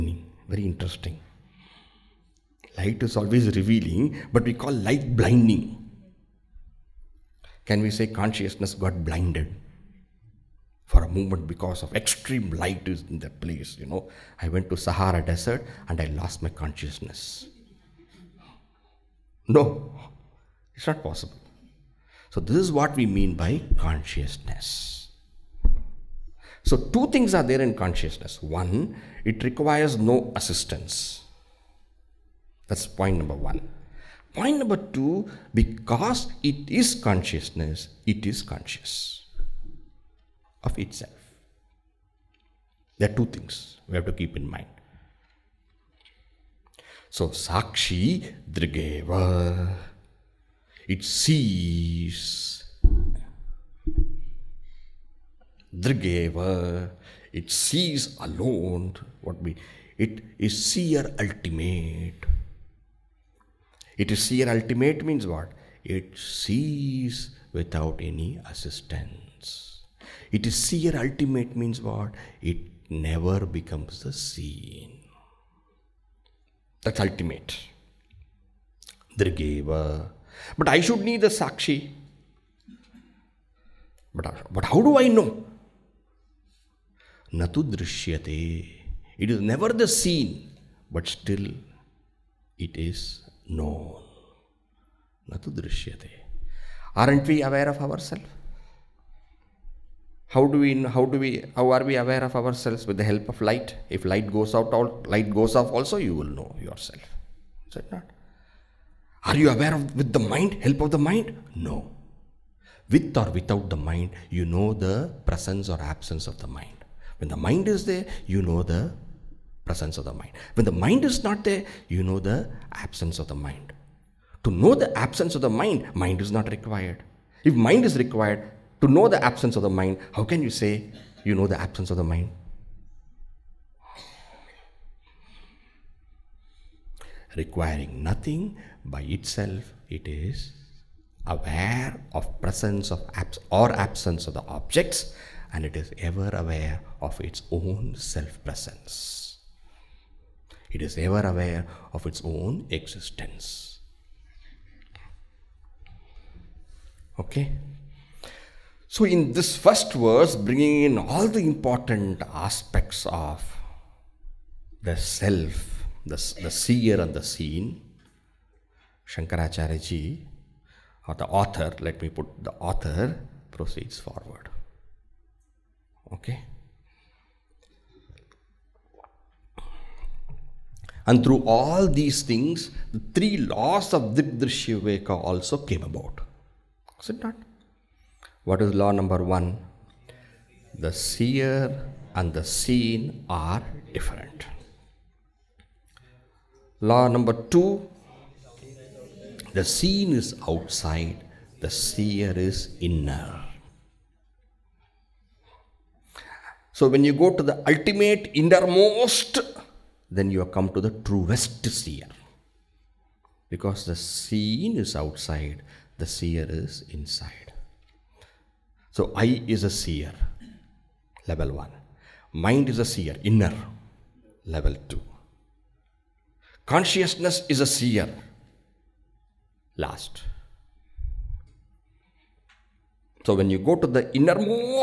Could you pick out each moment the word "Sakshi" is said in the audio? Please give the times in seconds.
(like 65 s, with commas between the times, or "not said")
47 s, 81 s.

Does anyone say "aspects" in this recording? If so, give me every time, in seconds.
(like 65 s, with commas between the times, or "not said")
162 s.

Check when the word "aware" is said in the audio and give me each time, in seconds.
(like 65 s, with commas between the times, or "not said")
97 s, 101 s, 109 s, 141 s, 146 s, 151 s.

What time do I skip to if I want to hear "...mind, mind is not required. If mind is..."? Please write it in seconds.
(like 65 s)
125 s.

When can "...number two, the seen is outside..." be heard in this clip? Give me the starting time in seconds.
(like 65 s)
197 s.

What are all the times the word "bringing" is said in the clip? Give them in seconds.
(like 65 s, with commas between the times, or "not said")
160 s.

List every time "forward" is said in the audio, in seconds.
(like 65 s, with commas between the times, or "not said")
173 s.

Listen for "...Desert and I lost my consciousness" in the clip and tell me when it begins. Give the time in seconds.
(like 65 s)
15 s.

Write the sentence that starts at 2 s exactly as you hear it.
Light is always revealing, but we call light blinding.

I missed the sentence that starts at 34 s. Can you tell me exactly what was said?
Point number two, because it is consciousness, it is conscious of itself.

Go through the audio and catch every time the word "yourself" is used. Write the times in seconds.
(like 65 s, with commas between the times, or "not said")
106 s.